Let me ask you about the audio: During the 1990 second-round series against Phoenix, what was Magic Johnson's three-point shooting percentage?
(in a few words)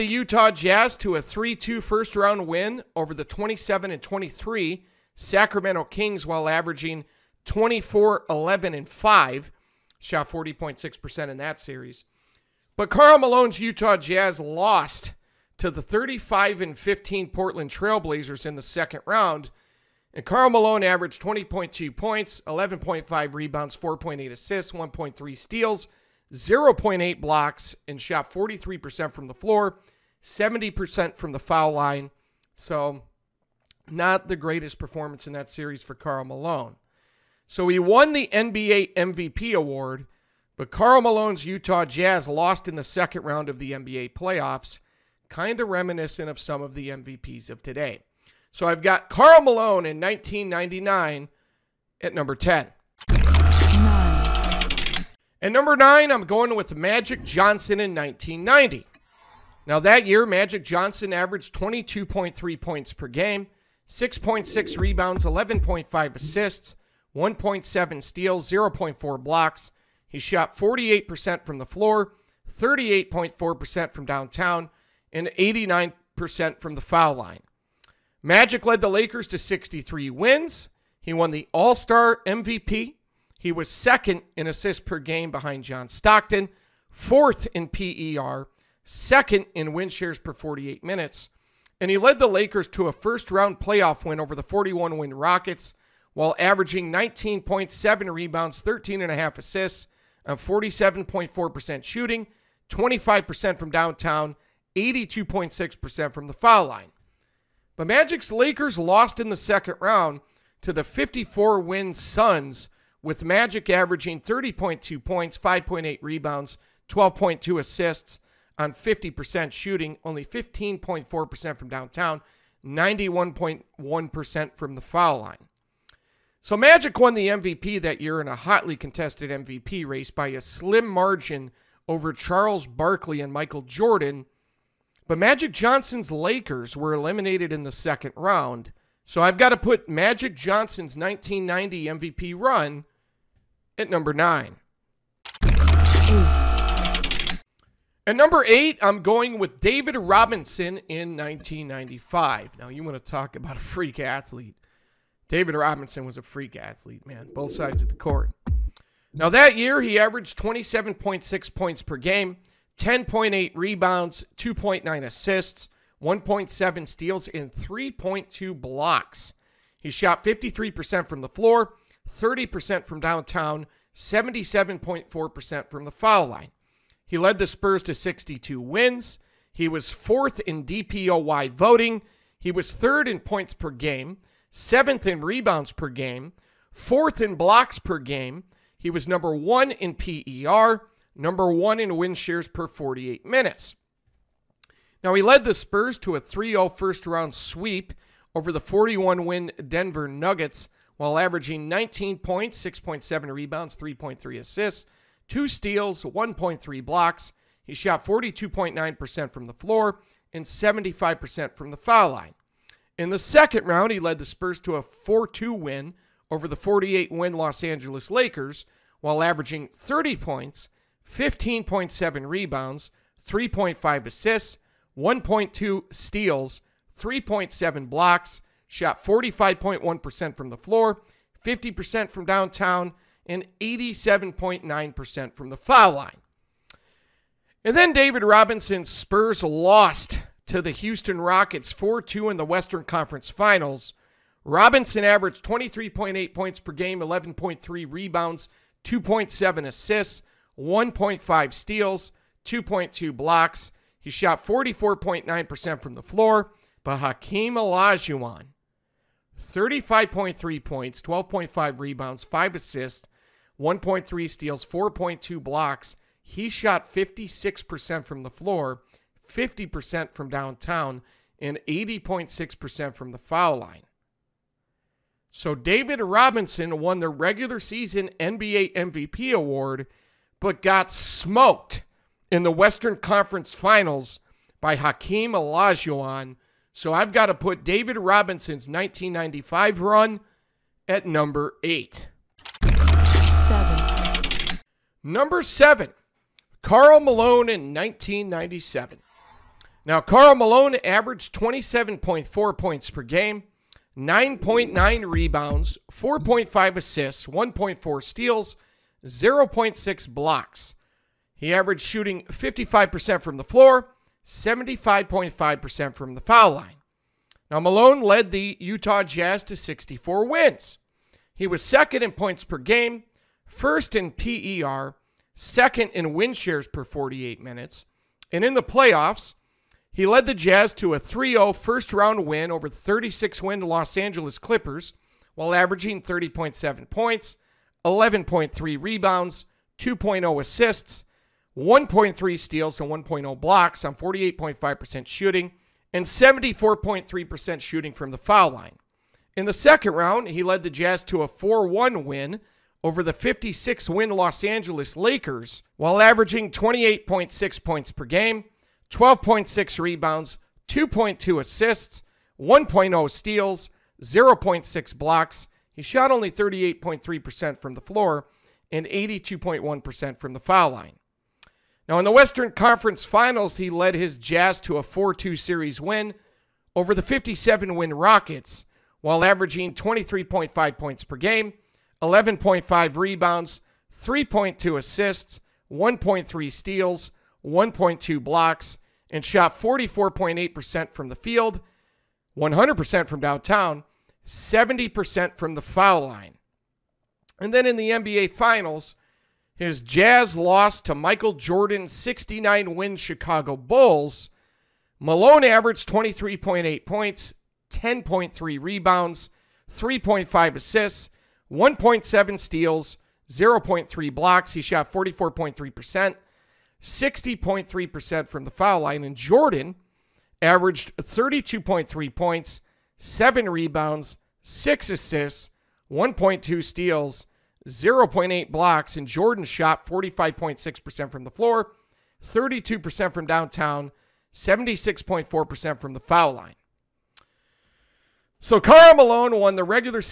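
15.4%.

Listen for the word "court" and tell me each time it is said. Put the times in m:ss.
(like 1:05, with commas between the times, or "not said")
2:37.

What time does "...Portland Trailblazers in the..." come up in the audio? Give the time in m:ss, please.
0:17.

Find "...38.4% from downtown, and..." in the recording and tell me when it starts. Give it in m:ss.
1:12.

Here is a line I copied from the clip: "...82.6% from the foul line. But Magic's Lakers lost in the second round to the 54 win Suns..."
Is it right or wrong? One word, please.
right.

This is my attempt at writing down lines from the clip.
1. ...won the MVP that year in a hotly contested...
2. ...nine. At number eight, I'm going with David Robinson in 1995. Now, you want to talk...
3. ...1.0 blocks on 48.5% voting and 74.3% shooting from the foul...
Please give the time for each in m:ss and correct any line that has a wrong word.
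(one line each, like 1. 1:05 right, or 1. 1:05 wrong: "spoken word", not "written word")
1. 2:06 right
2. 2:24 right
3. 5:42 wrong: "shooting", not "voting".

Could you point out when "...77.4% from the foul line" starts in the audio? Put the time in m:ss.
2:53.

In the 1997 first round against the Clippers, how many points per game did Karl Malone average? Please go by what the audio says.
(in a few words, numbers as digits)
30.7.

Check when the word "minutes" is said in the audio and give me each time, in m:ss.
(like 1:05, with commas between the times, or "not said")
1:30, 3:13, 5:27.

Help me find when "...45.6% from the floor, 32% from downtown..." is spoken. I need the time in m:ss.
7:09.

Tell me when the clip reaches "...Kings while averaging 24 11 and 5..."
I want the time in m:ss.
0:05.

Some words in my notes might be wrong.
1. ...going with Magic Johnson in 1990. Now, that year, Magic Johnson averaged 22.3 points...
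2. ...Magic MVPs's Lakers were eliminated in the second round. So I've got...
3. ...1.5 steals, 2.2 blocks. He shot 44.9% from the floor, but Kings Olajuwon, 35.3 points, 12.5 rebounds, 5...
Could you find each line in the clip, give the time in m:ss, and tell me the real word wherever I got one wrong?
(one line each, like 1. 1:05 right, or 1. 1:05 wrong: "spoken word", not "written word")
1. 0:56 right
2. 2:15 wrong: "Johnson", not "MVPs"
3. 4:10 wrong: "Hakeem", not "Kings".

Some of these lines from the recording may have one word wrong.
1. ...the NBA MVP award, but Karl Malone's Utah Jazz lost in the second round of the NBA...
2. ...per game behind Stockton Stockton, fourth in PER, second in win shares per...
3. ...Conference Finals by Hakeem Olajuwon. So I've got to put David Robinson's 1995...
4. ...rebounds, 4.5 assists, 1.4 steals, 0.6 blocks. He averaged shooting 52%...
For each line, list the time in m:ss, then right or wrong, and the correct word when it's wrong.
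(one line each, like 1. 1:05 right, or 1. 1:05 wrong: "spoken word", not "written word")
1. 0:38 right
2. 1:24 wrong: "John", not "Stockton"
3. 4:42 right
4. 5:05 wrong: "55", not "52".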